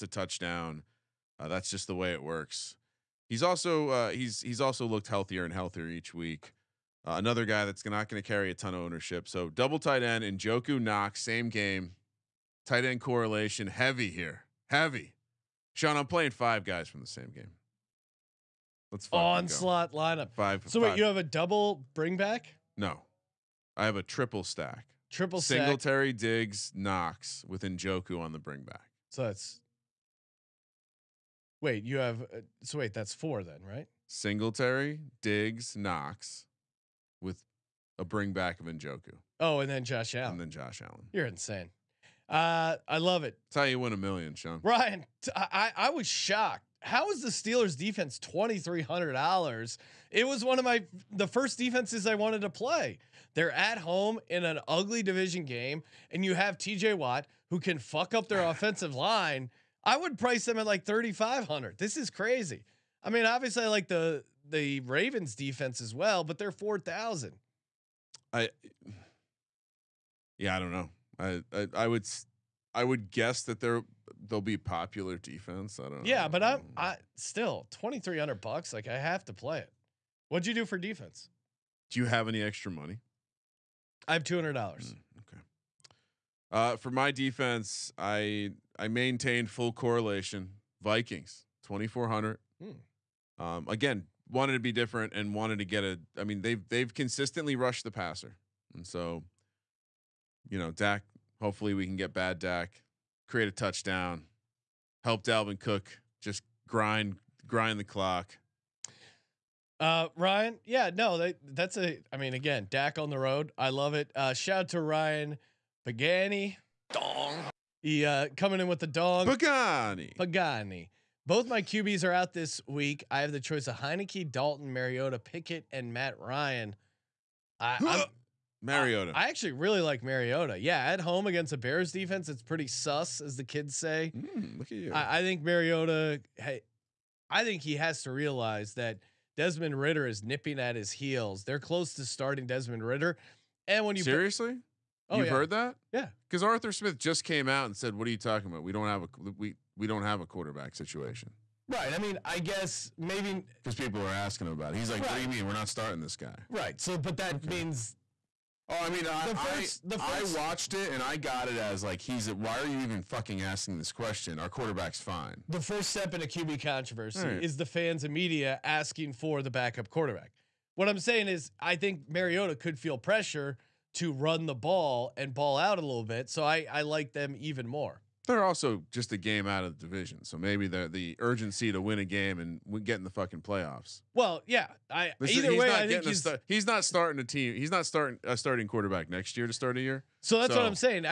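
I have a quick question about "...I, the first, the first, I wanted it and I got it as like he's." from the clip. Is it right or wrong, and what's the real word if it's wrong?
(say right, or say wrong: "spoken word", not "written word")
wrong: "watched", not "wanted".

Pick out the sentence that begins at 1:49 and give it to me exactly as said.
Uh, Ryan, yeah, no, that's a.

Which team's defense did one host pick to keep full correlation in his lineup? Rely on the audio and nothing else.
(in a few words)
Vikings.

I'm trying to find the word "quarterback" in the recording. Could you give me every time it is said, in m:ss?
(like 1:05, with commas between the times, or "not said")
2:30, 2:44, 2:49, 3:08.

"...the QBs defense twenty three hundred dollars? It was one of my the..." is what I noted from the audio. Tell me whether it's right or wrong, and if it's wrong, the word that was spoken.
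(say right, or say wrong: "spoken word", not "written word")
wrong: "Steelers", not "QBs".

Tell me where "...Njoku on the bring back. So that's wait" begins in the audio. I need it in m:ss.
0:27.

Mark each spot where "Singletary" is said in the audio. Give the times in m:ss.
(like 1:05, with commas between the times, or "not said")
0:25, 0:34.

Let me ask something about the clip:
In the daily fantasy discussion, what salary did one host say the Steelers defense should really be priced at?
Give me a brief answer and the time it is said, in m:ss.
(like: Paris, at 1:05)
$3,500, at 1:00.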